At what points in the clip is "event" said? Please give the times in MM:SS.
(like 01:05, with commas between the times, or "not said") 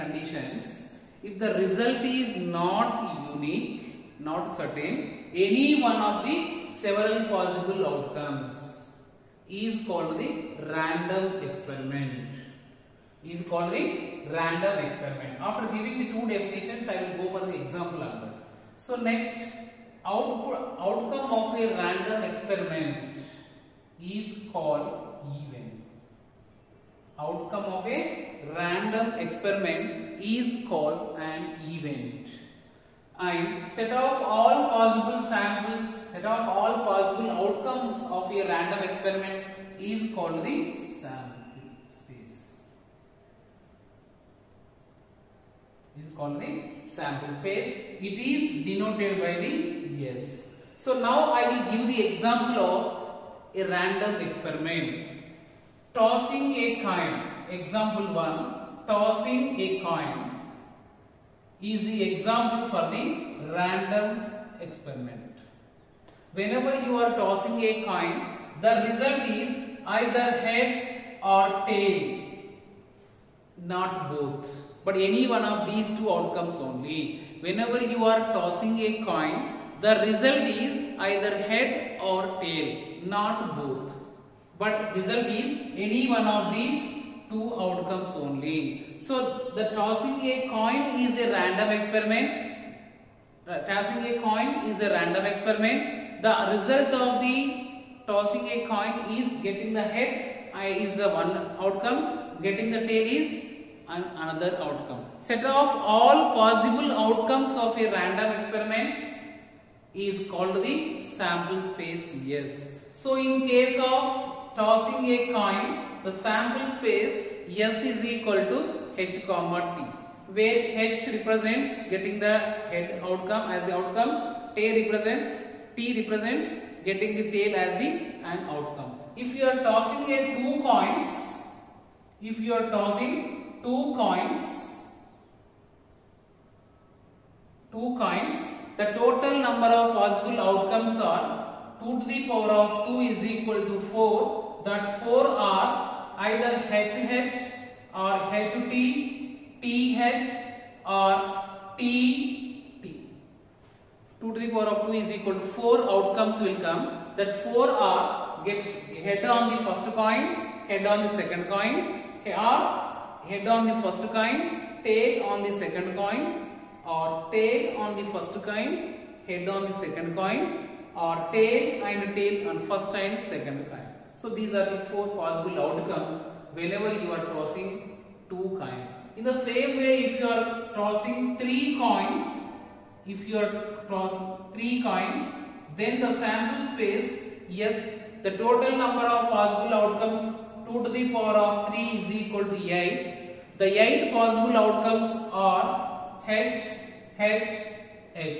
00:25, 00:31.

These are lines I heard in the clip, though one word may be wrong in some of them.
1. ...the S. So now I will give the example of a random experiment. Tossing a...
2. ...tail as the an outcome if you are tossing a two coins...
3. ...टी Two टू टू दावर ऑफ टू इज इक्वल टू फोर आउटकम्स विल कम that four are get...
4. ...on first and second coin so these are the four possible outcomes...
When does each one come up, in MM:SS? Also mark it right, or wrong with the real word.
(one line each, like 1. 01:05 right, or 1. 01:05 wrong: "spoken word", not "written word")
1. 00:49 right
2. 02:07 right
3. 02:31 right
4. 02:52 right.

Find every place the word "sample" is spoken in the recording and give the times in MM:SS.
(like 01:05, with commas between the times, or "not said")
00:35, 00:40, 00:46, 01:51, 01:56, 03:06.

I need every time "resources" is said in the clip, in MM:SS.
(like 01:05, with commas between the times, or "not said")
not said.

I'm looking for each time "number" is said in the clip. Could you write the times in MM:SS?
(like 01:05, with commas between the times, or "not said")
02:19, 03:08.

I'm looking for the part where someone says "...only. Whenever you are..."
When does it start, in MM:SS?
01:16.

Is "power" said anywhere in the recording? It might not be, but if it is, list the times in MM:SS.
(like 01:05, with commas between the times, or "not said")
02:22, 03:11.